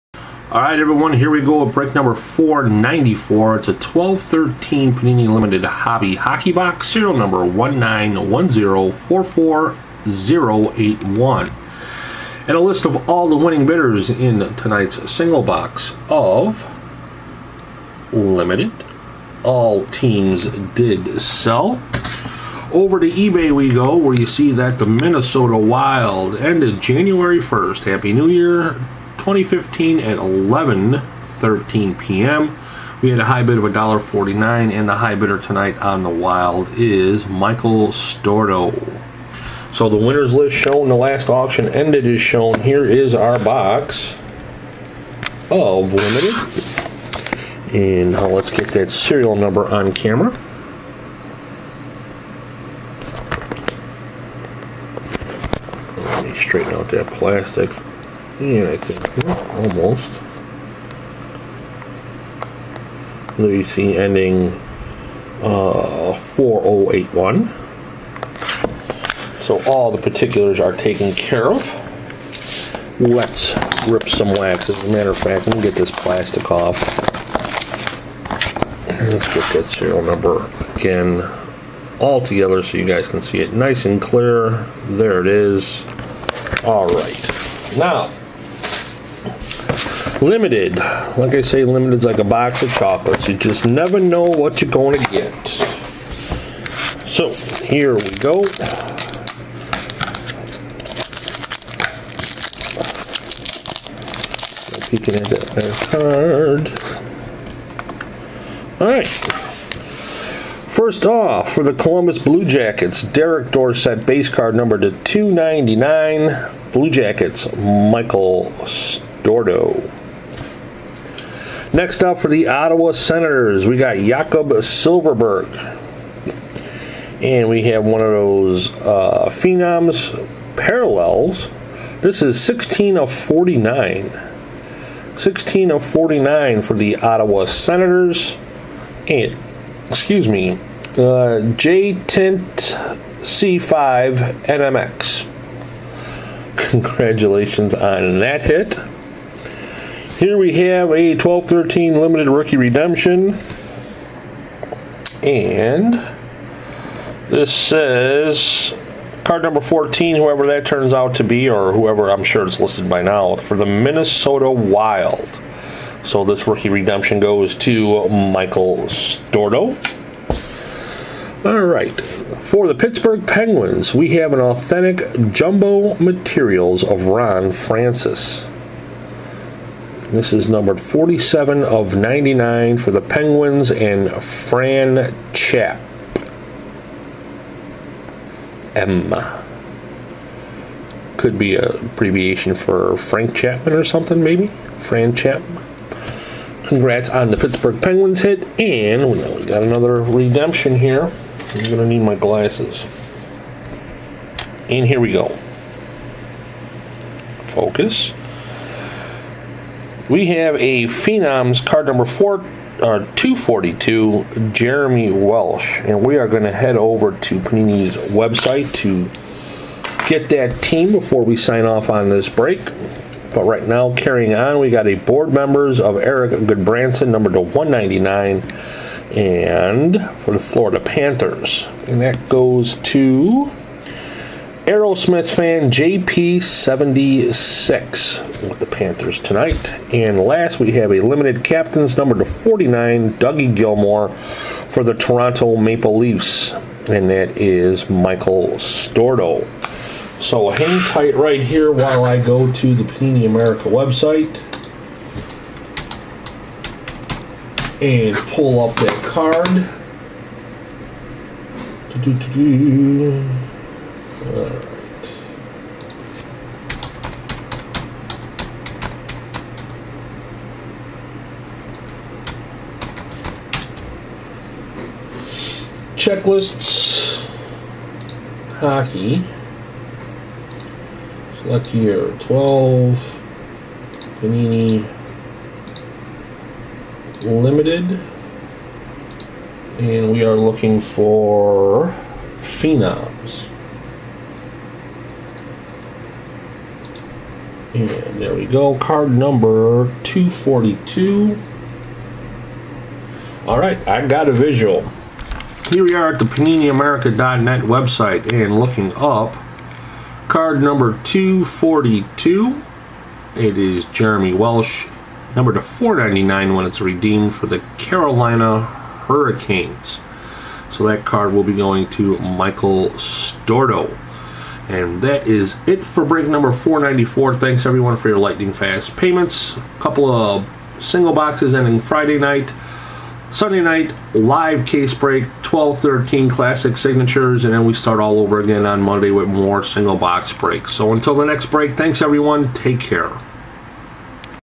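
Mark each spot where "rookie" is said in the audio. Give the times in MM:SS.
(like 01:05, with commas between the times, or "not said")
02:32, 02:46.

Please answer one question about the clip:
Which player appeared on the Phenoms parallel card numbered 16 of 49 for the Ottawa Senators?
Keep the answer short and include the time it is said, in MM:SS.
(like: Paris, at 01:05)
Jakob Silfverberg, at 02:03.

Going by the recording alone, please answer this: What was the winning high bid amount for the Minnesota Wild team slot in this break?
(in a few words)
$1.49.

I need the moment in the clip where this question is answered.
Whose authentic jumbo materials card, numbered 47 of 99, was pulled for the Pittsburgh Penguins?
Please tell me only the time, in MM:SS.
02:57.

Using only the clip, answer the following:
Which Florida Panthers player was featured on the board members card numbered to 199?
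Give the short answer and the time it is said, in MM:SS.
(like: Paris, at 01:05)
Erik Gudbranson, at 03:45.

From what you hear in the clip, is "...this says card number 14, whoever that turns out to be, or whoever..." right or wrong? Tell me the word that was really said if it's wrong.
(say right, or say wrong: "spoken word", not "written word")
right.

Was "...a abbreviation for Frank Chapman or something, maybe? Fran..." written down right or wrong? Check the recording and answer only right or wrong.
right.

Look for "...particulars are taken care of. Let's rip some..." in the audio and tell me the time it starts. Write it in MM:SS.
01:10.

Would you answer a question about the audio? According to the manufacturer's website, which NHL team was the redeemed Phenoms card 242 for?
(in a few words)
Carolina Hurricanes.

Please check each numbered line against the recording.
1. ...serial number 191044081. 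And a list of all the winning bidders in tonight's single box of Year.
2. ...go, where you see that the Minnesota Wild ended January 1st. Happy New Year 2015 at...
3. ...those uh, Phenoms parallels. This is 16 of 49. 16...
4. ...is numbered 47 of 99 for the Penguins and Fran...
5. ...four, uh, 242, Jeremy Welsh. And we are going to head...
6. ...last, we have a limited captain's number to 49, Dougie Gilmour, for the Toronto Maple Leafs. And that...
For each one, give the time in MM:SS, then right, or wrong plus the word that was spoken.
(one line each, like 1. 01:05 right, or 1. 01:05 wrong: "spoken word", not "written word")
1. 00:06 wrong: "Limited", not "Year"
2. 00:23 right
3. 02:08 right
4. 03:00 right
5. 03:32 right
6. 04:00 right.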